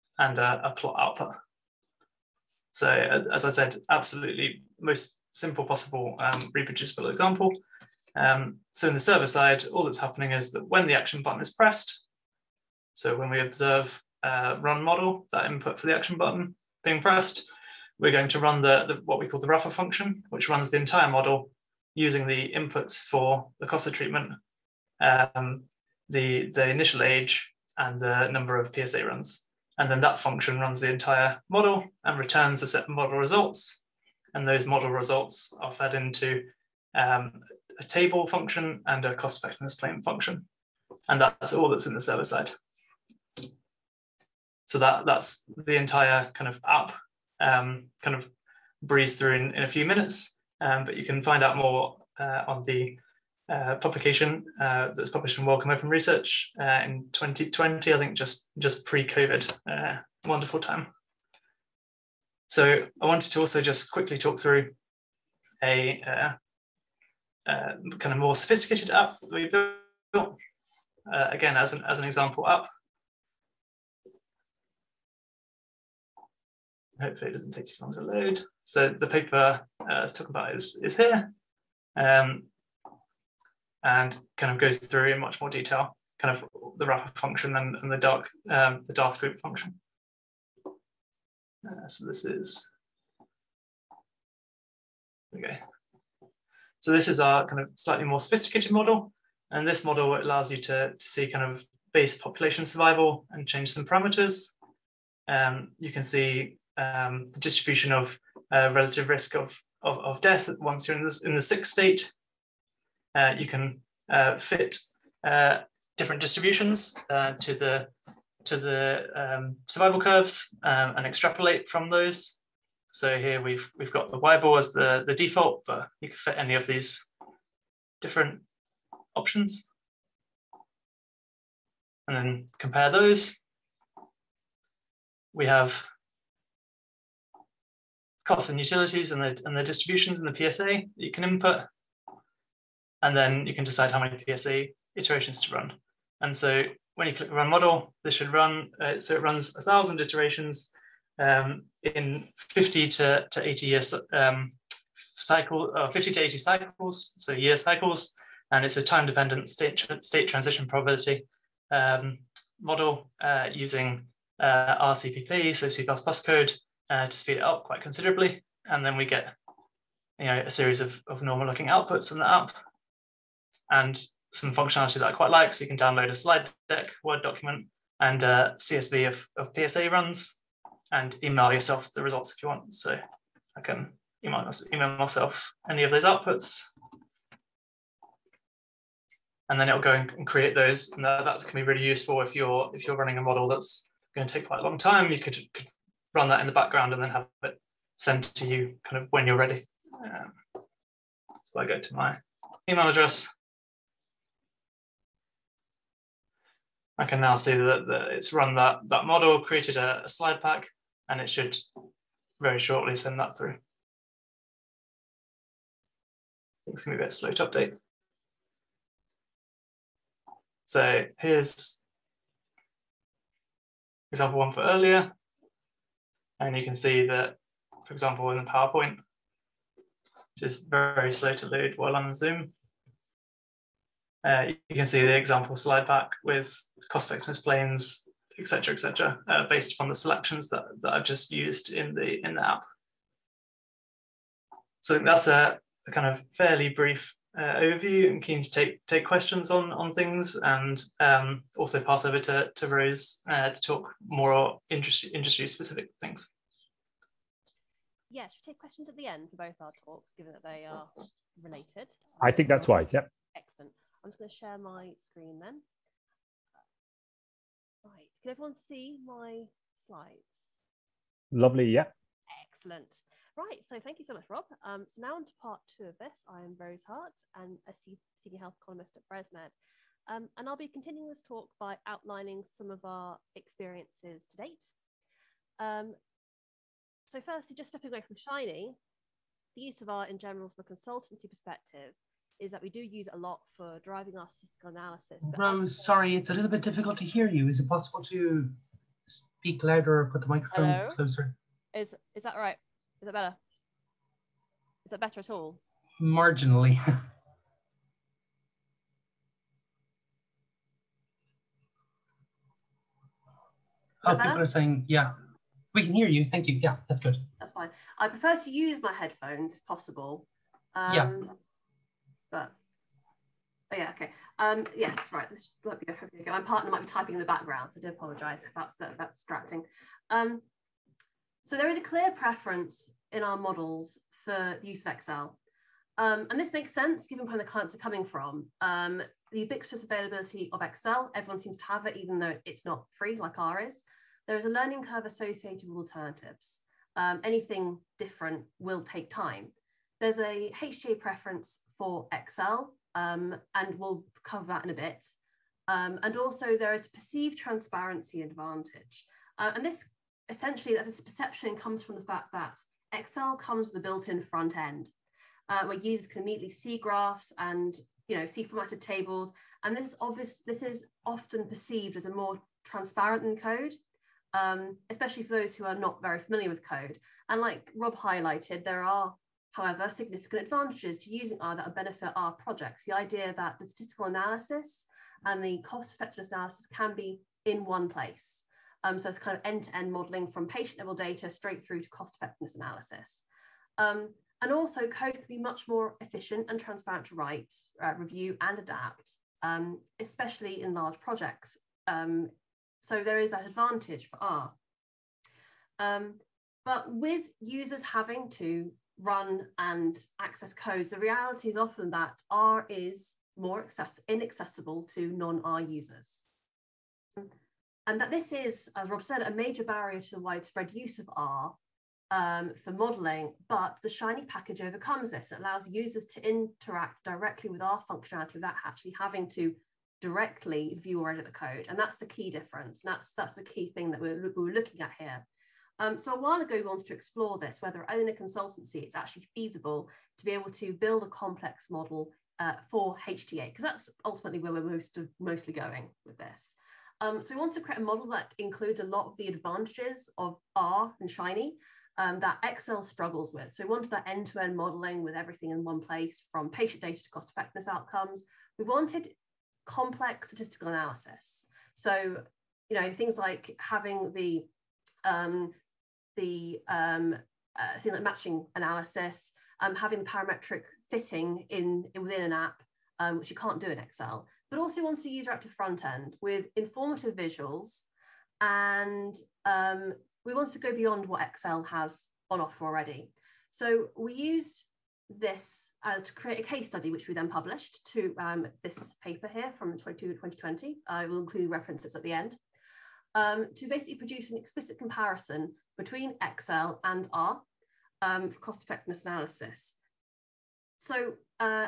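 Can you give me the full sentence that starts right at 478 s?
And um, we want to go beyond what Excel has on offer already.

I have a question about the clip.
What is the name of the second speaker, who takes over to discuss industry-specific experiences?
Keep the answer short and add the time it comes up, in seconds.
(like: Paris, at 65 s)
Rose Hart, at 276 s.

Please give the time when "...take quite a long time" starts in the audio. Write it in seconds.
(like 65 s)
194 s.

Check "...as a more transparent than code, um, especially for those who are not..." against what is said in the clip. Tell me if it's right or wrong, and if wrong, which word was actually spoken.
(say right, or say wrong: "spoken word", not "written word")
right.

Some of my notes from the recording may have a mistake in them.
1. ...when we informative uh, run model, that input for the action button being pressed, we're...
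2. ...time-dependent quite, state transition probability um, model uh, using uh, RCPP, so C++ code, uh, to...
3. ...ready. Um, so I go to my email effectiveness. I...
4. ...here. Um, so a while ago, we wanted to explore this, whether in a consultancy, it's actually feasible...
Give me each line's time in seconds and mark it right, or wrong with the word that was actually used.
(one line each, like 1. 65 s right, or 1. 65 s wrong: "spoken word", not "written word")
1. 13 s wrong: "observe", not "informative"
2. 158 s wrong: "state", not "quite"
3. 199 s wrong: "address", not "effectiveness"
4. 434 s right.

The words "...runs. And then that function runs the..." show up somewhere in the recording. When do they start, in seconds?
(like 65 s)
29 s.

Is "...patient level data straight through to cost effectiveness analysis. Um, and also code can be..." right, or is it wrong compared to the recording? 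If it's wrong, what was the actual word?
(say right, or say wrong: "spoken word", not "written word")
right.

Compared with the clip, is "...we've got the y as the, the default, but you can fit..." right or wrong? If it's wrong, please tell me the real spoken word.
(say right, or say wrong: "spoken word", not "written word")
right.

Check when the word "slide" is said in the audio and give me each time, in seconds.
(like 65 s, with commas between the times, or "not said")
176 s, 210 s, 235 s, 269 s.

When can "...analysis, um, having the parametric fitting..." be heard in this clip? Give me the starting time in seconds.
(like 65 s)
468 s.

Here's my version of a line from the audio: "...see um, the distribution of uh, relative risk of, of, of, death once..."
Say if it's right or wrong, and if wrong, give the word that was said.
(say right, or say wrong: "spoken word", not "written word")
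right.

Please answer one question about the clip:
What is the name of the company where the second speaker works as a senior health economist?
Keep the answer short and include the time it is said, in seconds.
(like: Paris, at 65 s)
BresMed, at 279 s.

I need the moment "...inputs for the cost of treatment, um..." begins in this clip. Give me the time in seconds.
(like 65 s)
22 s.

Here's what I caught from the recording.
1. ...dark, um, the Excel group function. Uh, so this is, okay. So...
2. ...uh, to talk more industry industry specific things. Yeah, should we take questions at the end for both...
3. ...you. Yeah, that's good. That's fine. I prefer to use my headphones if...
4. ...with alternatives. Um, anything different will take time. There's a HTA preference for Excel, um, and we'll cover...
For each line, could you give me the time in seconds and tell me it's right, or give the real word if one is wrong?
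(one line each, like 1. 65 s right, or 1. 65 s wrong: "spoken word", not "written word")
1. 87 s wrong: "DARTH", not "Excel"
2. 253 s right
3. 316 s right
4. 345 s right.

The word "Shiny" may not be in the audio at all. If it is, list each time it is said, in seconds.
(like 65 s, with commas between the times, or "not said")
288 s, 423 s, 451 s.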